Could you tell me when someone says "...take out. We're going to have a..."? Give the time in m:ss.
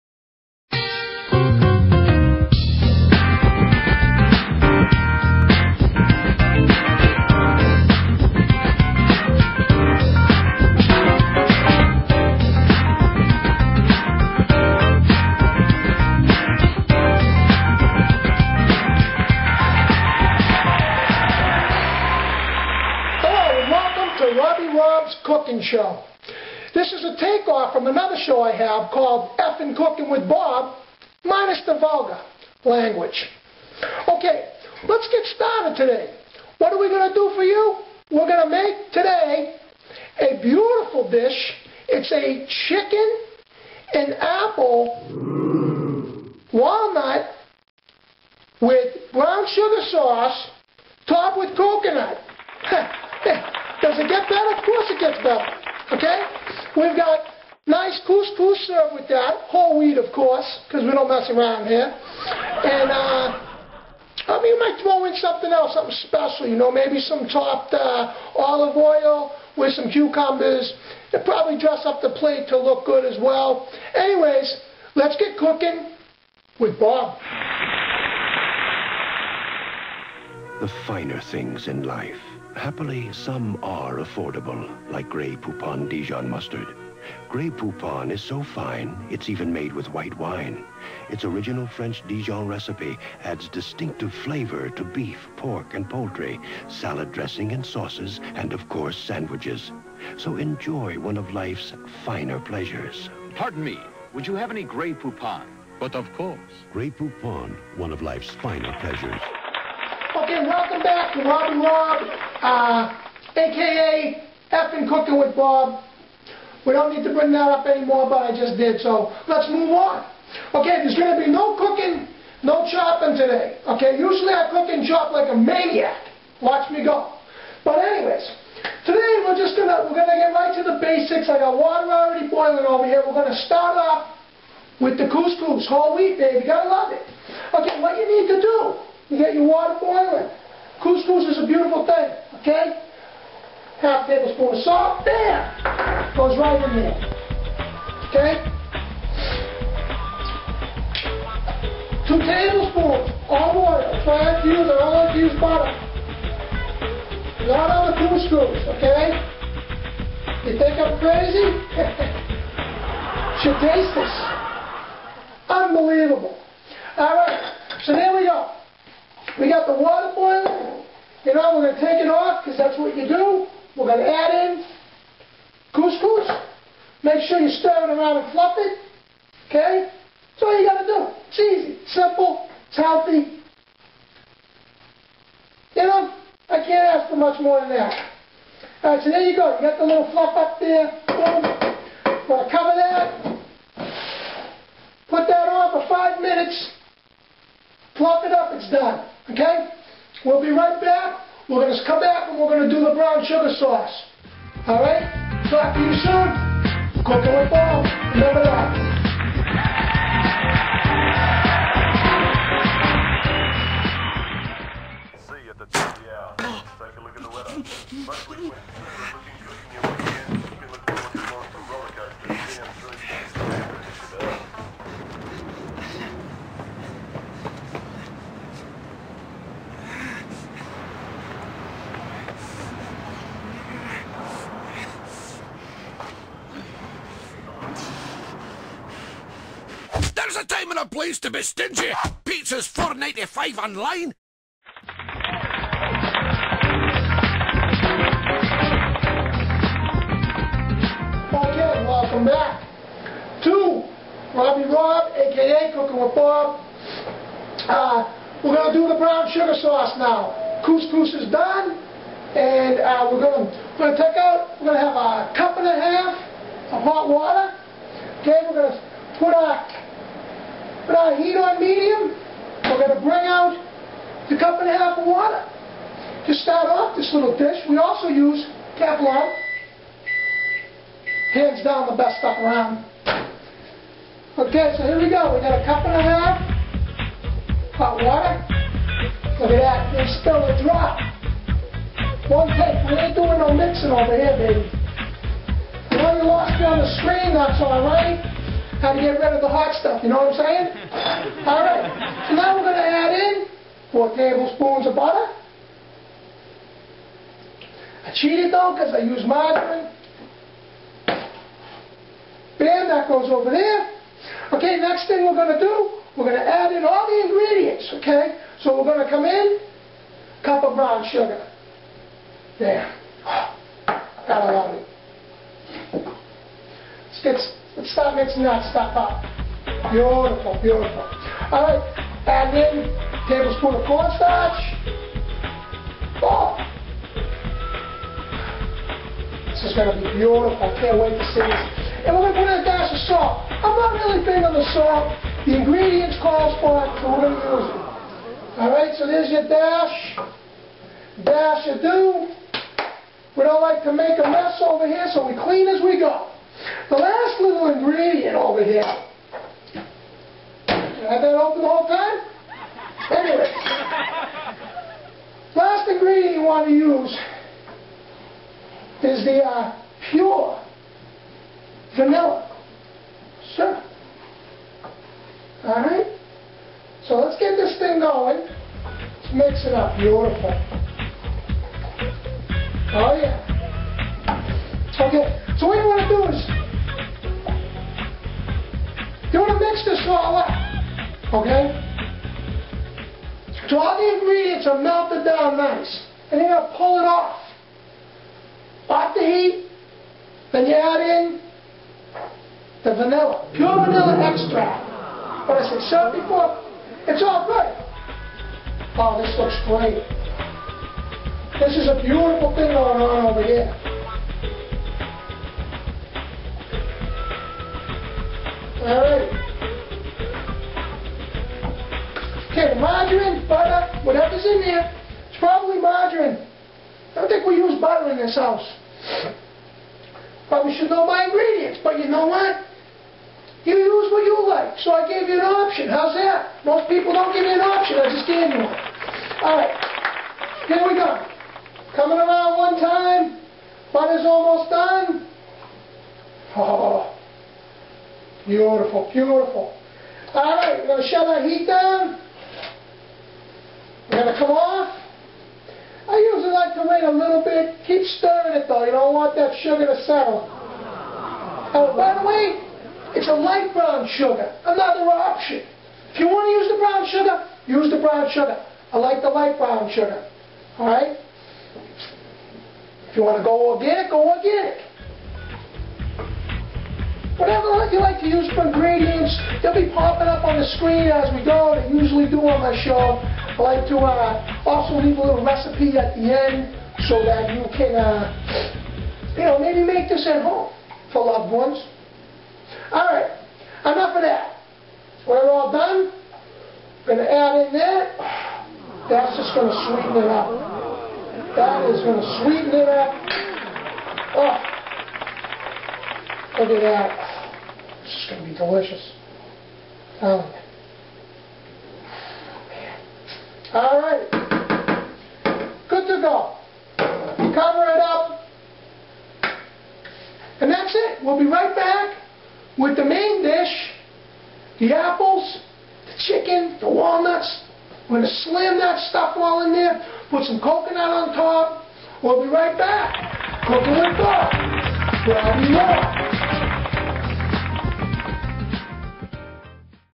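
4:23.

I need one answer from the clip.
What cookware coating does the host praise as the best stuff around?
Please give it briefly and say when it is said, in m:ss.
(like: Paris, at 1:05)
Teflon, at 4:38.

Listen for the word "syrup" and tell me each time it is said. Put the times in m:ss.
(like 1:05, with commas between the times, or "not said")
6:13.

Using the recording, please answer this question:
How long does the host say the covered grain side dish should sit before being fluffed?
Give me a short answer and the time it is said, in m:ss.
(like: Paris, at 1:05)
five minutes, at 3:15.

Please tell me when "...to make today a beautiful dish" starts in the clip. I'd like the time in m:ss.
0:38.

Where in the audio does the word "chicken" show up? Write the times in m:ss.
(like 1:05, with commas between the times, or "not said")
0:42, 8:46.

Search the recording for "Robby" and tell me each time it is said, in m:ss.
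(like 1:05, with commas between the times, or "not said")
1:51, 4:14.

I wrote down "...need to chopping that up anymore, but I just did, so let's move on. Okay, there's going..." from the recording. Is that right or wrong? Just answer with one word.
wrong.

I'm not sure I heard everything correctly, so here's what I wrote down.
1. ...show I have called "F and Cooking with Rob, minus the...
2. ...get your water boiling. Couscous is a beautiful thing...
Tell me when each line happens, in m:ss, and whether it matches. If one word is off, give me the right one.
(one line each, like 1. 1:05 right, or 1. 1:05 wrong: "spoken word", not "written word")
1. 0:28 wrong: "Bob", not "Rob"
2. 2:19 right.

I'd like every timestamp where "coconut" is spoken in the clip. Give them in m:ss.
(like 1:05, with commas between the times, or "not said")
0:51, 8:50.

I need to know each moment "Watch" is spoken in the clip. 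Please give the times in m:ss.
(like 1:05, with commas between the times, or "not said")
2:06.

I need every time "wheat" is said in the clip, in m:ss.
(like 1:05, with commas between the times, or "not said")
0:59, 2:15.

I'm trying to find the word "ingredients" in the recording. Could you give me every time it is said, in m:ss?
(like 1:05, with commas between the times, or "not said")
5:17, 5:45, 5:57, 6:05, 6:34, 7:11, 7:58.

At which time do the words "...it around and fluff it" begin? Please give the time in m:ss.
2:57.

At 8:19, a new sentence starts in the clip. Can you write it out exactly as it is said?
That's just going to sweeten it up.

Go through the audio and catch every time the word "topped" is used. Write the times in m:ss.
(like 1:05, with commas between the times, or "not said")
0:51.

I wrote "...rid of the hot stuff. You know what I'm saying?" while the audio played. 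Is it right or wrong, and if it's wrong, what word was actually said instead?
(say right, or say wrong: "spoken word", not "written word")
right.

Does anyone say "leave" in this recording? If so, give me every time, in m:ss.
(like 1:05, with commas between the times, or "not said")
8:05.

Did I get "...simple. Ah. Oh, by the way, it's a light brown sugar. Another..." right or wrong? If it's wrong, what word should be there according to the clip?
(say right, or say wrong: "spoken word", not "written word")
wrong: "settle", not "simple".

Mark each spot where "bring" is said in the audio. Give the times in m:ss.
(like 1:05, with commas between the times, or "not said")
1:57, 4:33.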